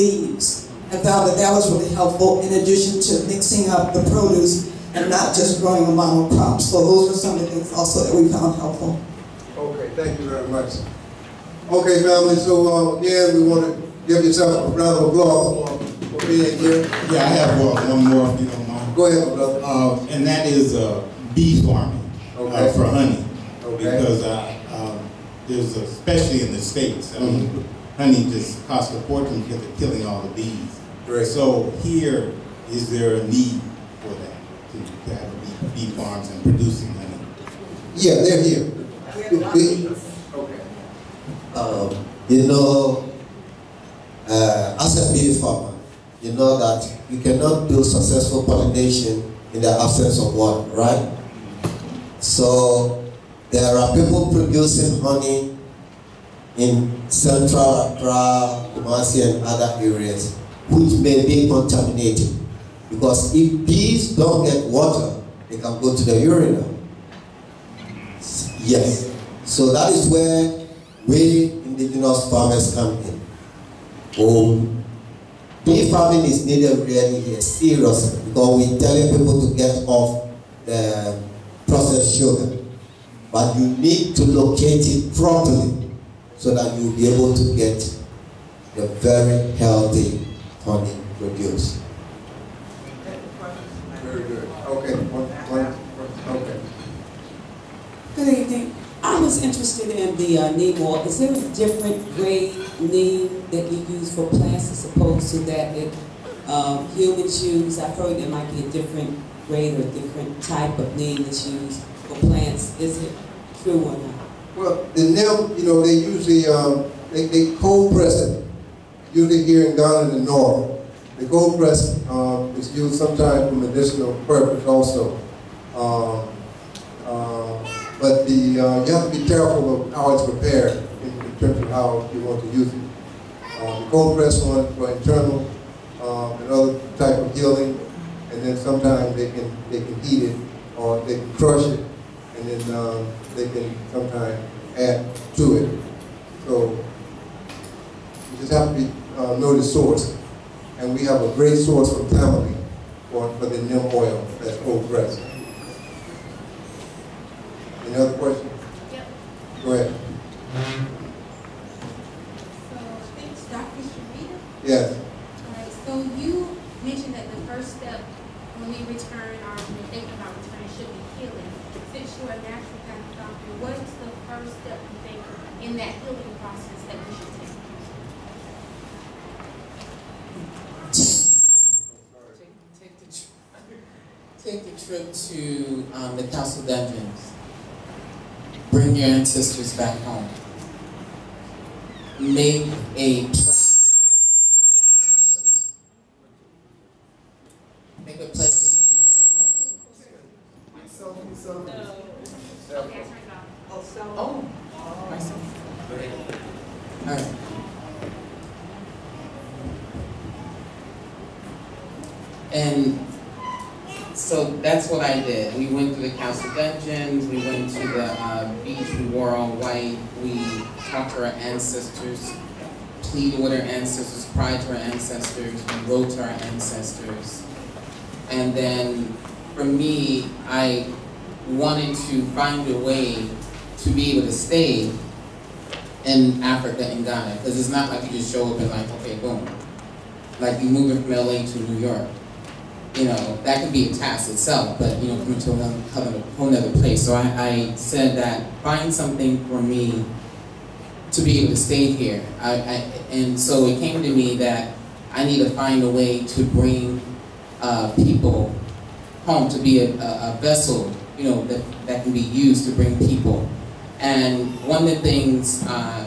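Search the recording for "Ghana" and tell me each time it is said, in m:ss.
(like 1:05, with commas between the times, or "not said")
1:59, 3:57.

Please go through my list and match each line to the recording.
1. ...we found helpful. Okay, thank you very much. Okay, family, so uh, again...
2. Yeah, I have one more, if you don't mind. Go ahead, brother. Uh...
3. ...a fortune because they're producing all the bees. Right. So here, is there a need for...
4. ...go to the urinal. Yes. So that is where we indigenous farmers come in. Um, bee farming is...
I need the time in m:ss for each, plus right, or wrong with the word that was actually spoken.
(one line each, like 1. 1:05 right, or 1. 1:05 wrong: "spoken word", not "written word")
1. 0:08 right
2. 0:17 right
3. 0:28 wrong: "killing", not "producing"
4. 1:05 right.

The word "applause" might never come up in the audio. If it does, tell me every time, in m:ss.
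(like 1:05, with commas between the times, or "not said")
0:15.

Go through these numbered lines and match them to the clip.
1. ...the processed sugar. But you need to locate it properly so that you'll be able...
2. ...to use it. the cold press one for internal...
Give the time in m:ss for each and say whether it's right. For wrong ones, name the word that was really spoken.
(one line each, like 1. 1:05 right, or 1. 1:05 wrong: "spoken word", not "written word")
1. 1:20 right
2. 2:12 right.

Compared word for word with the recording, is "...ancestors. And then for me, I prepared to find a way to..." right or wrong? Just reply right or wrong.
wrong.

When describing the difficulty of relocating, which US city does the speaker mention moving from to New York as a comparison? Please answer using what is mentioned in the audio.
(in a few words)
LA.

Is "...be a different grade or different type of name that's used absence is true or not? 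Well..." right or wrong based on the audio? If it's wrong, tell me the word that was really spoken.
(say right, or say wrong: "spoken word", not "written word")
wrong: "compliance", not "absence".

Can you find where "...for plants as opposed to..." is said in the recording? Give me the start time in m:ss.
1:44.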